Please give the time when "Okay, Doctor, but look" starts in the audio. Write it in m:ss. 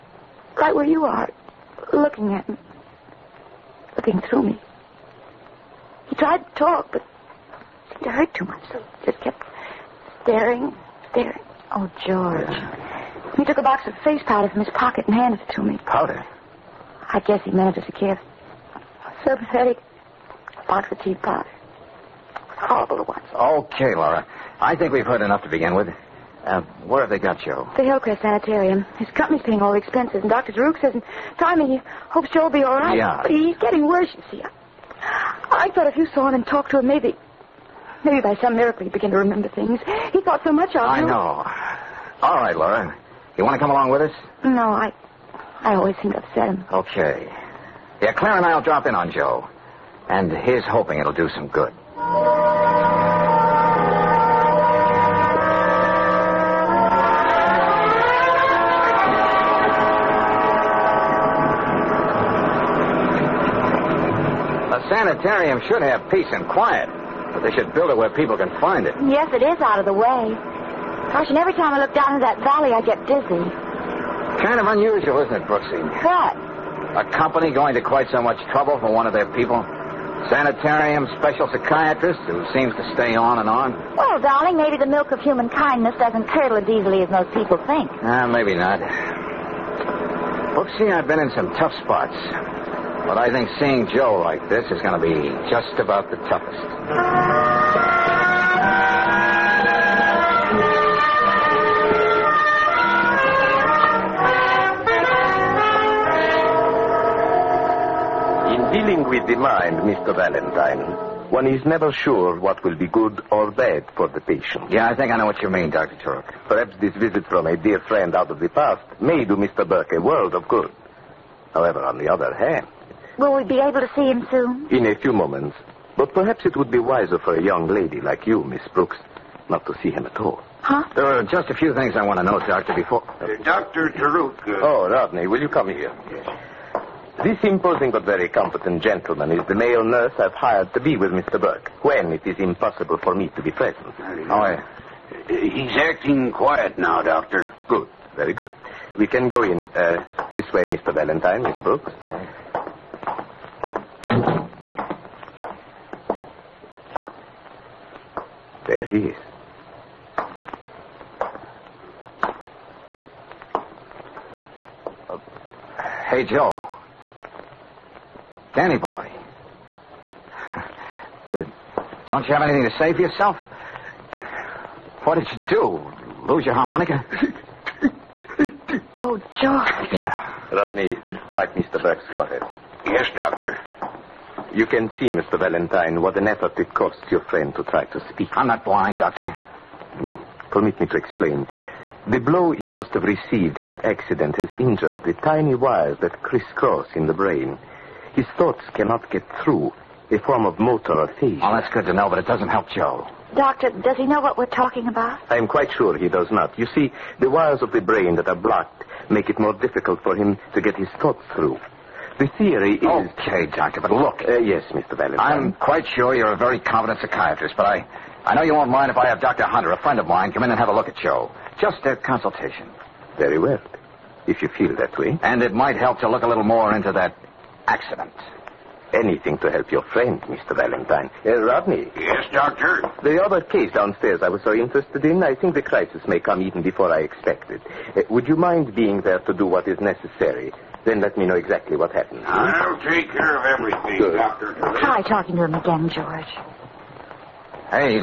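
3:32.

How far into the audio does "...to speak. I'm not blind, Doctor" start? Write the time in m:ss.
3:07.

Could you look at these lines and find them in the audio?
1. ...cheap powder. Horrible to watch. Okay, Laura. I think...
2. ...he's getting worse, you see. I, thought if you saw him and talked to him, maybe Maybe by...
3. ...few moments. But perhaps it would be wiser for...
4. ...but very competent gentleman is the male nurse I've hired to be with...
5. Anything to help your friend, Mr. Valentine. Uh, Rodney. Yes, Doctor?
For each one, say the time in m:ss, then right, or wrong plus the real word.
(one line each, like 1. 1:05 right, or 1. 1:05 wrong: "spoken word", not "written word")
1. 0:21 right
2. 0:33 right
3. 2:04 right
4. 2:17 right
5. 3:48 right.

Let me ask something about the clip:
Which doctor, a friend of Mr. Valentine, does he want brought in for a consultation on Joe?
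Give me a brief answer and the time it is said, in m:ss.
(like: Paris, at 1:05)
Dr. Hunter, at 3:39.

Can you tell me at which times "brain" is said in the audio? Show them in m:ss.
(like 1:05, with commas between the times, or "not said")
3:17, 3:27.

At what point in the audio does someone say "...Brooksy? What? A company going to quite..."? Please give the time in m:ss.
1:15.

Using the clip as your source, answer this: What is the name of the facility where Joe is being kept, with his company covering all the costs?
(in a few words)
Hillcrest Sanitarium.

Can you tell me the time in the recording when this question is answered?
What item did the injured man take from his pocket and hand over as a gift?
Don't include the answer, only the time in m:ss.
0:14.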